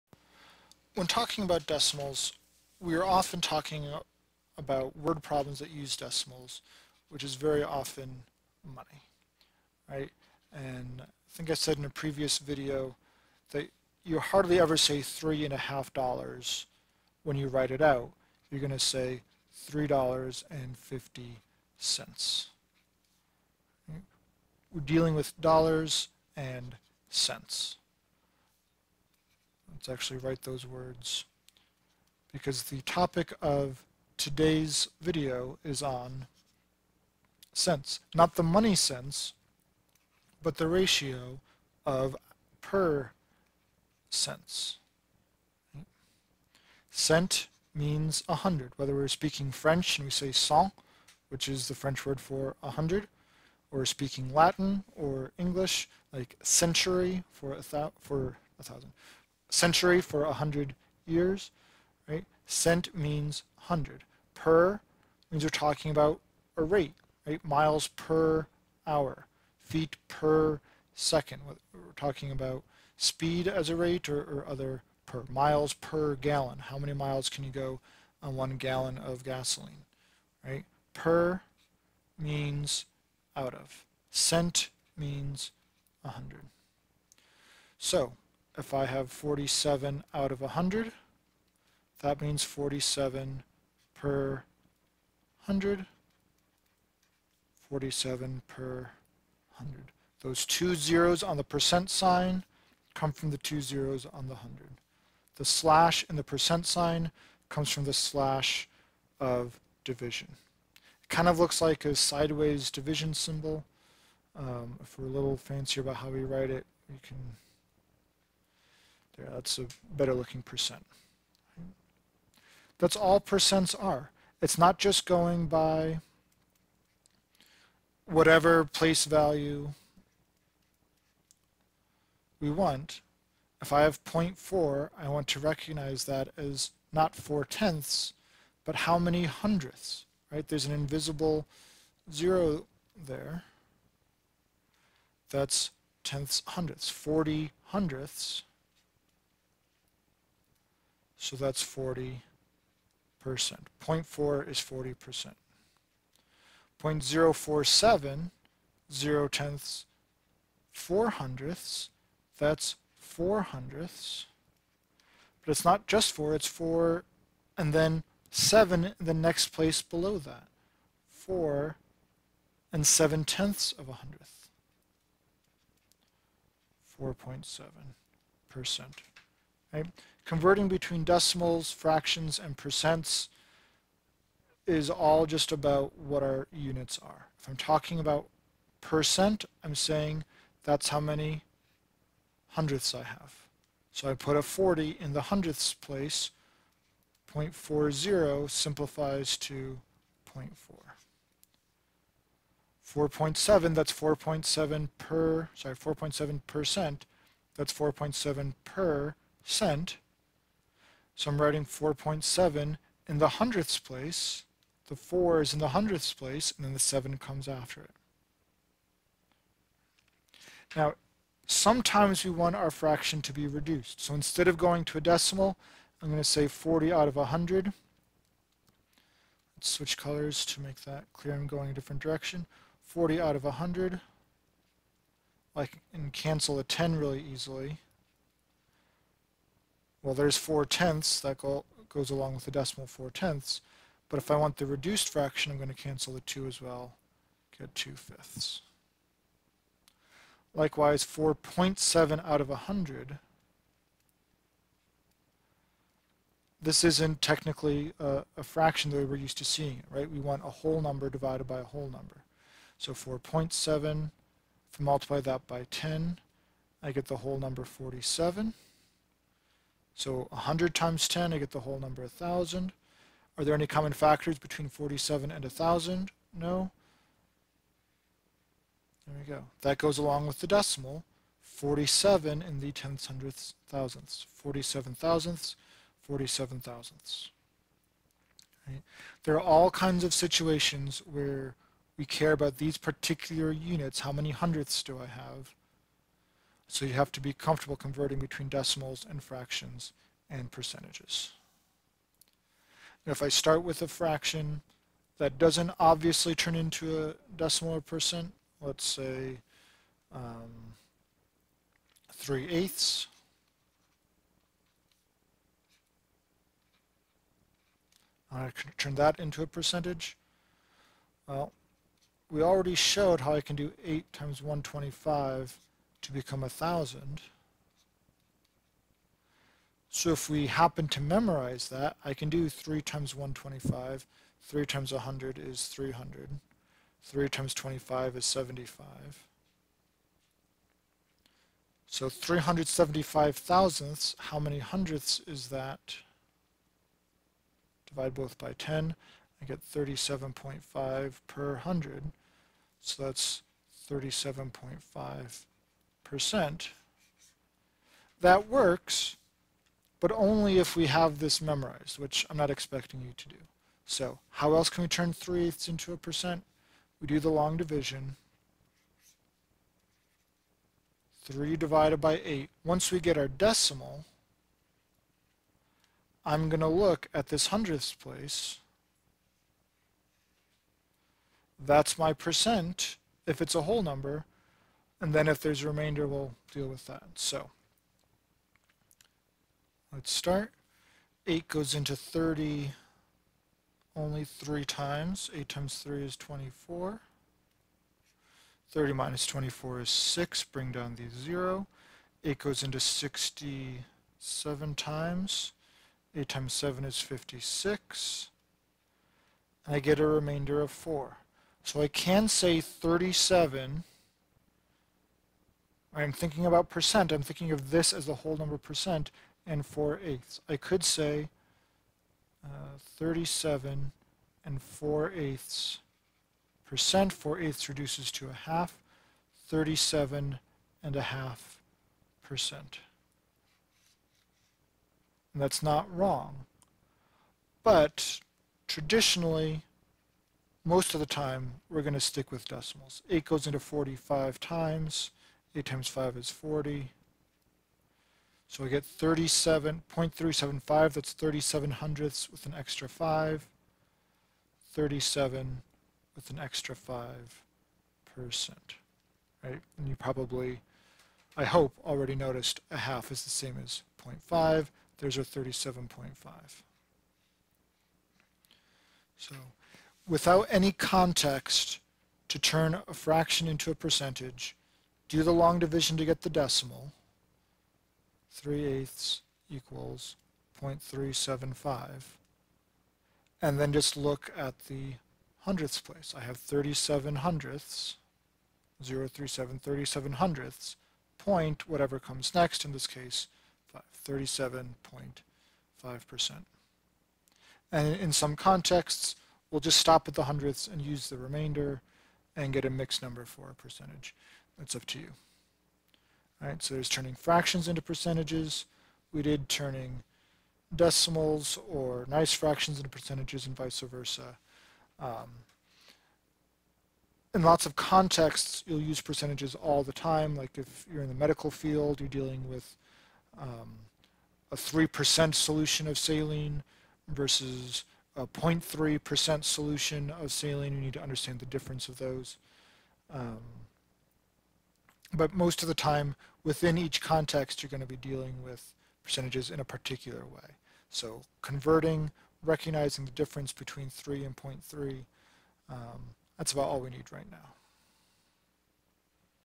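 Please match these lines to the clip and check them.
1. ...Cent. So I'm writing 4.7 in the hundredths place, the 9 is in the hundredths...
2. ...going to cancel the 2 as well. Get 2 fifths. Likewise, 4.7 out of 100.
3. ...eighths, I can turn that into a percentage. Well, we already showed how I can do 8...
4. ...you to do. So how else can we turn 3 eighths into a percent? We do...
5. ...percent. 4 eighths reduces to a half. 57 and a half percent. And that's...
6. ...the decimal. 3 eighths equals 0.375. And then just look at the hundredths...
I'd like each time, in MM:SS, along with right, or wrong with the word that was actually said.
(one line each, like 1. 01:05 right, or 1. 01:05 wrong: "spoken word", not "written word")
1. 03:29 wrong: "4", not "9"
2. 04:05 right
3. 05:12 right
4. 06:03 right
5. 07:06 wrong: "37", not "57"
6. 07:56 right.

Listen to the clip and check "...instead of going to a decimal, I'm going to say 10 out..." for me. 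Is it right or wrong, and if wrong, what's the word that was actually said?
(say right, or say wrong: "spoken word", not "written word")
wrong: "40", not "10".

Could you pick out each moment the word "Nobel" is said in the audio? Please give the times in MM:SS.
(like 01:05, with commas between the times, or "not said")
not said.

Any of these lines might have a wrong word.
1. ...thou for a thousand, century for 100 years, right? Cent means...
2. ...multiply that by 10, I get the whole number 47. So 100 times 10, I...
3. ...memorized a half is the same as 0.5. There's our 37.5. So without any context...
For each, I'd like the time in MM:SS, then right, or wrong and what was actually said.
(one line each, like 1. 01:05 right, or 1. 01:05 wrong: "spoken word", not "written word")
1. 00:57 right
2. 04:24 right
3. 07:42 wrong: "noticed", not "memorized".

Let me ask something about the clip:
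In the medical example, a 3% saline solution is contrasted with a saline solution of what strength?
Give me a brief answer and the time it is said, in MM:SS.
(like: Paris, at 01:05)
0.3%, at 08:48.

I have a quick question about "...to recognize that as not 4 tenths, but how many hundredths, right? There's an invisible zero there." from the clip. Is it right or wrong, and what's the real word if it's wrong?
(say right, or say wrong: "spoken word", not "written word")
right.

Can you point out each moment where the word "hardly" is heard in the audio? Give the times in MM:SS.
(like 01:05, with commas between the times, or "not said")
00:14.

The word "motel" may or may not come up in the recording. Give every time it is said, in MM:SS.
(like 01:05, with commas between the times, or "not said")
not said.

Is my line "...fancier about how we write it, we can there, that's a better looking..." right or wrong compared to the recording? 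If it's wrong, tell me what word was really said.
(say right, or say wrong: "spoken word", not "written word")
right.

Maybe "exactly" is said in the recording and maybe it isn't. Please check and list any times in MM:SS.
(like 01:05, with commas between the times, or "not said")
not said.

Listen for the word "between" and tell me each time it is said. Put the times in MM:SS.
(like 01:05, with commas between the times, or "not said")
03:00, 04:34, 04:58, 09:03.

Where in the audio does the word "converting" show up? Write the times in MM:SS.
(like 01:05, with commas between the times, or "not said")
03:00, 04:57, 09:01.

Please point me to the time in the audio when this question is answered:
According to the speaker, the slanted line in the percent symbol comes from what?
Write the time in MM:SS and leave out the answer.
01:47.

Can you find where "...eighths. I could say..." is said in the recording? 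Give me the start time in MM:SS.
07:00.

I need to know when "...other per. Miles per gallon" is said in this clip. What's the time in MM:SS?
01:14.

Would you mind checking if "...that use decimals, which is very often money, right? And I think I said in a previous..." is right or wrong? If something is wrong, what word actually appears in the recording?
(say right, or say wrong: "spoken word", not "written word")
right.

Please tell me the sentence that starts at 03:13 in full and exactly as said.
So I put a 40 in the hundredths place.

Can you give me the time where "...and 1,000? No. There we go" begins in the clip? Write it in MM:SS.
04:35.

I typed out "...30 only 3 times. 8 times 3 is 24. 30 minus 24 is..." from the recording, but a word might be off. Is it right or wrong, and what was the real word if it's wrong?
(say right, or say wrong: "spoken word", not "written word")
right.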